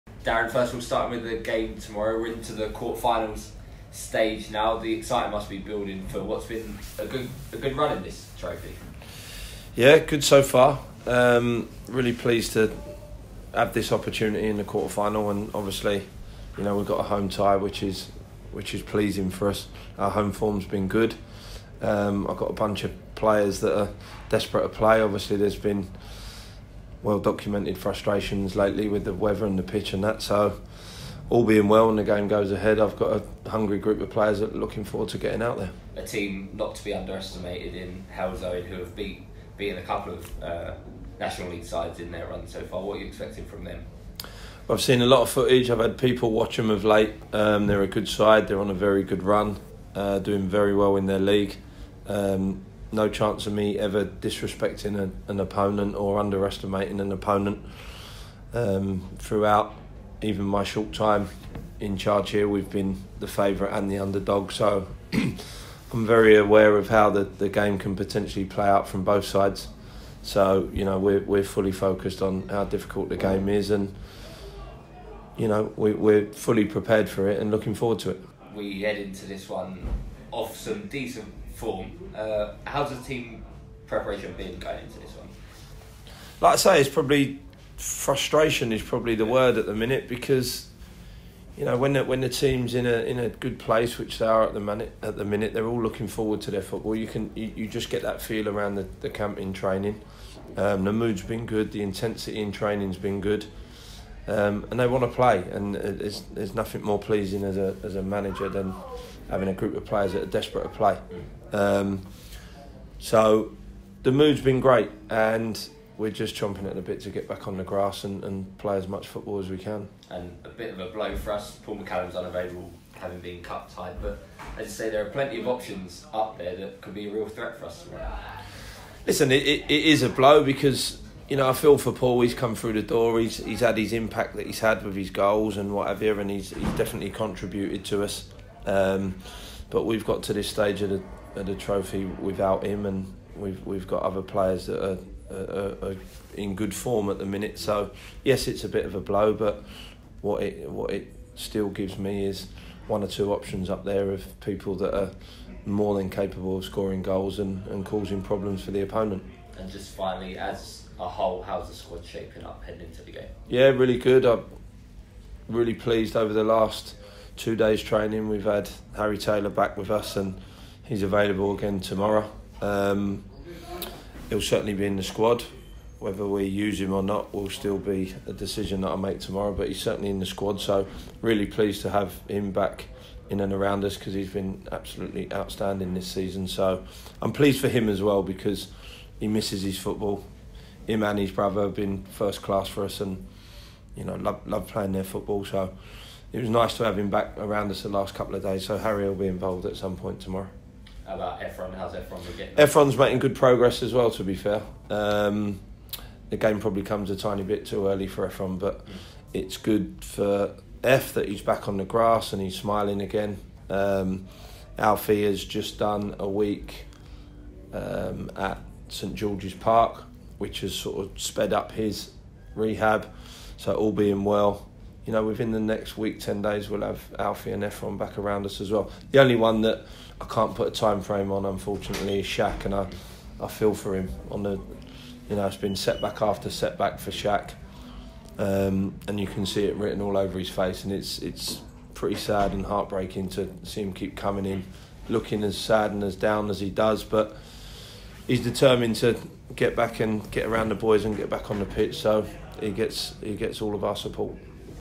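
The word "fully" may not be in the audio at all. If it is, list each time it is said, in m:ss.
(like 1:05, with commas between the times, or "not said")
1:11, 1:16.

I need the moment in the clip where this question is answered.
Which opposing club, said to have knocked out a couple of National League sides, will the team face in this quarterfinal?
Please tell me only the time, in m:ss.
0:38.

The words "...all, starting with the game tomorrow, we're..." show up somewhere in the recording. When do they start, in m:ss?
0:00.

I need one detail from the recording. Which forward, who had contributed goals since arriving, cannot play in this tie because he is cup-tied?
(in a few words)
Paul McCallum.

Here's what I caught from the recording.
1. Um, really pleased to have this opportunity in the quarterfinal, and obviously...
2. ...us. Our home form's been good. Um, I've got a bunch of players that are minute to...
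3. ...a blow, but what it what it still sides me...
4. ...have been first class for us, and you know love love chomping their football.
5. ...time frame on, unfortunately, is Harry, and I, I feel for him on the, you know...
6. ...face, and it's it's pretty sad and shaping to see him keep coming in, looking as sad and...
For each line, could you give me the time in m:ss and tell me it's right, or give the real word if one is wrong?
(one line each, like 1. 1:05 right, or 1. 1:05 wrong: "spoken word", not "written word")
1. 0:11 right
2. 0:19 wrong: "desperate", not "minute"
3. 2:28 wrong: "gives", not "sides"
4. 3:11 wrong: "playing", not "chomping"
5. 3:50 wrong: "Shaq", not "Harry"
6. 4:00 wrong: "heartbreaking", not "shaping".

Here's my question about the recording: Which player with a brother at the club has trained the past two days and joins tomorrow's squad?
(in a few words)
Harry Taylor.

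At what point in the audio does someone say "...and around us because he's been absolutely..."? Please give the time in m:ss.
3:03.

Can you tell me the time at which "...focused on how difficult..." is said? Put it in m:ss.
1:11.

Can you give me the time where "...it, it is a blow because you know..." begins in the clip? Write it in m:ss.
2:09.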